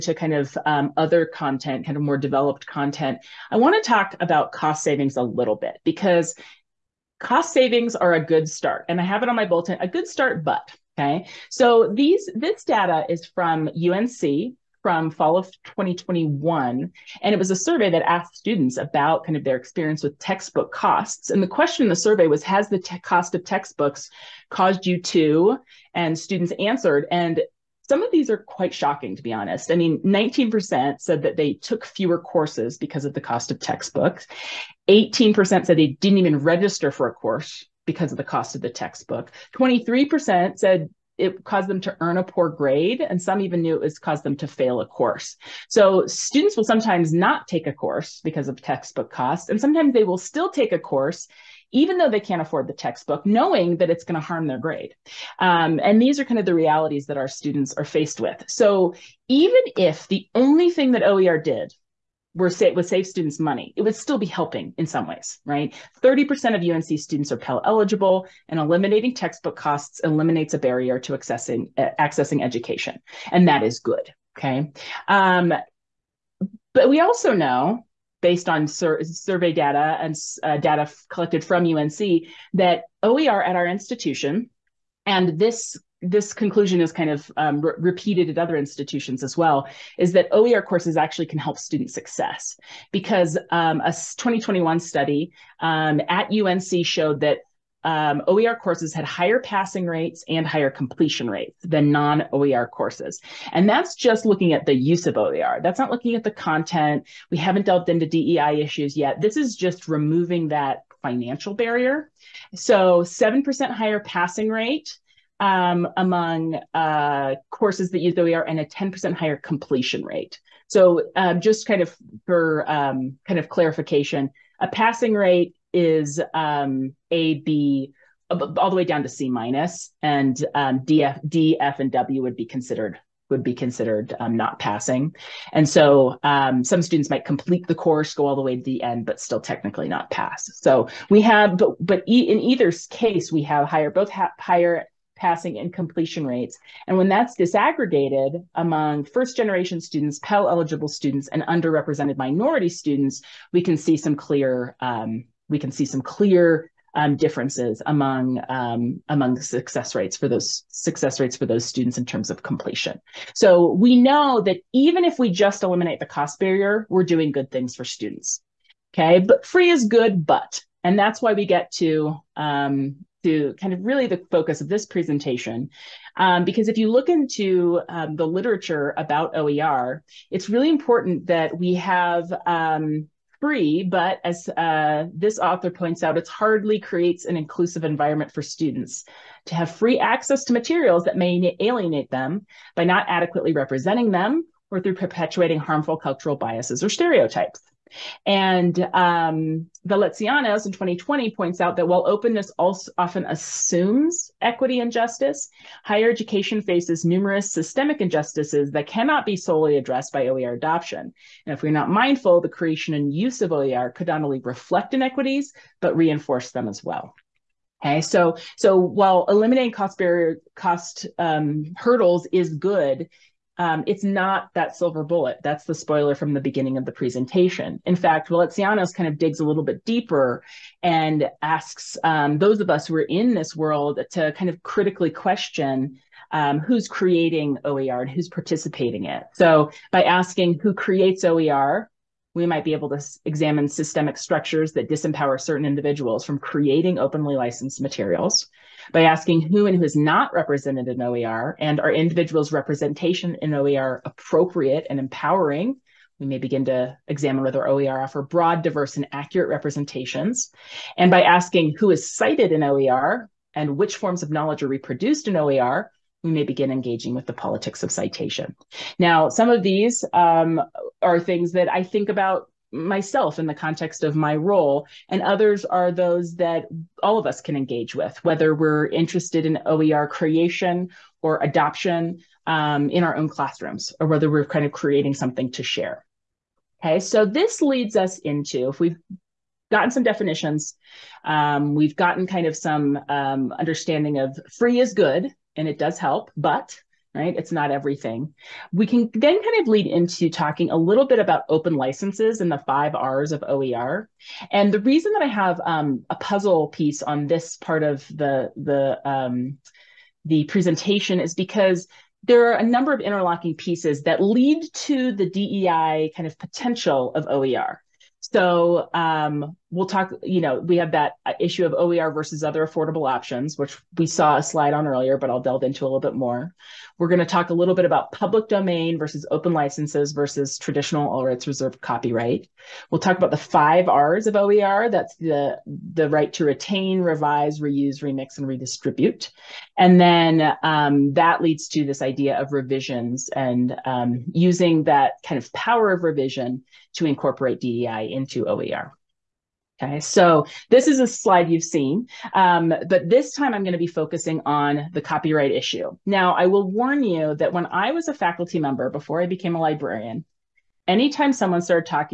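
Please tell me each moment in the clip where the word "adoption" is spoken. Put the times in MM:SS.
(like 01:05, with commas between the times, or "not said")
03:30, 04:41.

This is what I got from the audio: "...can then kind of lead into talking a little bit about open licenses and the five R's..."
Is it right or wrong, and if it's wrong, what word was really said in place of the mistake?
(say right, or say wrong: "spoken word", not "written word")
right.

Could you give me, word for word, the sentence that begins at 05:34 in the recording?
That's the, the right to retain, revise, reuse, remix, and redistribute.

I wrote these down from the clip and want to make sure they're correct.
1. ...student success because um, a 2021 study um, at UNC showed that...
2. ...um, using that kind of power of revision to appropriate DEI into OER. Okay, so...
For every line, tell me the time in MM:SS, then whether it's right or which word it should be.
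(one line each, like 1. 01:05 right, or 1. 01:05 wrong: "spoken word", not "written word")
1. 01:31 right
2. 05:43 wrong: "incorporate", not "appropriate".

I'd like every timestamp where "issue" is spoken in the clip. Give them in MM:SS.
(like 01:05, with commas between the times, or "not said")
01:48, 05:21, 05:55.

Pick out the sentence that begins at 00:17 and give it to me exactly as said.
And it was a survey that asked students about kind of their experience with textbook costs.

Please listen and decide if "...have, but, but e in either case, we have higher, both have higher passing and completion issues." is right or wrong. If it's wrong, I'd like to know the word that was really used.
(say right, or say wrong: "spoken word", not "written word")
wrong: "rates", not "issues".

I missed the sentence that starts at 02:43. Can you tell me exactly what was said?
So we know that even if we just eliminate the cost barrier, we're doing good things for students.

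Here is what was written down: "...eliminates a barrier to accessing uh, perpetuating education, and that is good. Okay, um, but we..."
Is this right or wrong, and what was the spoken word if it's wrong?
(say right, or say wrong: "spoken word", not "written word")
wrong: "accessing", not "perpetuating".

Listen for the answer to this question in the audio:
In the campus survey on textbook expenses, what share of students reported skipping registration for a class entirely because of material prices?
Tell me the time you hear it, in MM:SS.
00:34.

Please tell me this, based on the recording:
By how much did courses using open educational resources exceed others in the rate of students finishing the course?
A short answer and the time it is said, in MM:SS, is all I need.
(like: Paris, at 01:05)
10%, at 01:58.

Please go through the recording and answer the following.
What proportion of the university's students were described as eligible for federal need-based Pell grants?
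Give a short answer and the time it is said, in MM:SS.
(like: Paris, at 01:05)
30%, at 01:06.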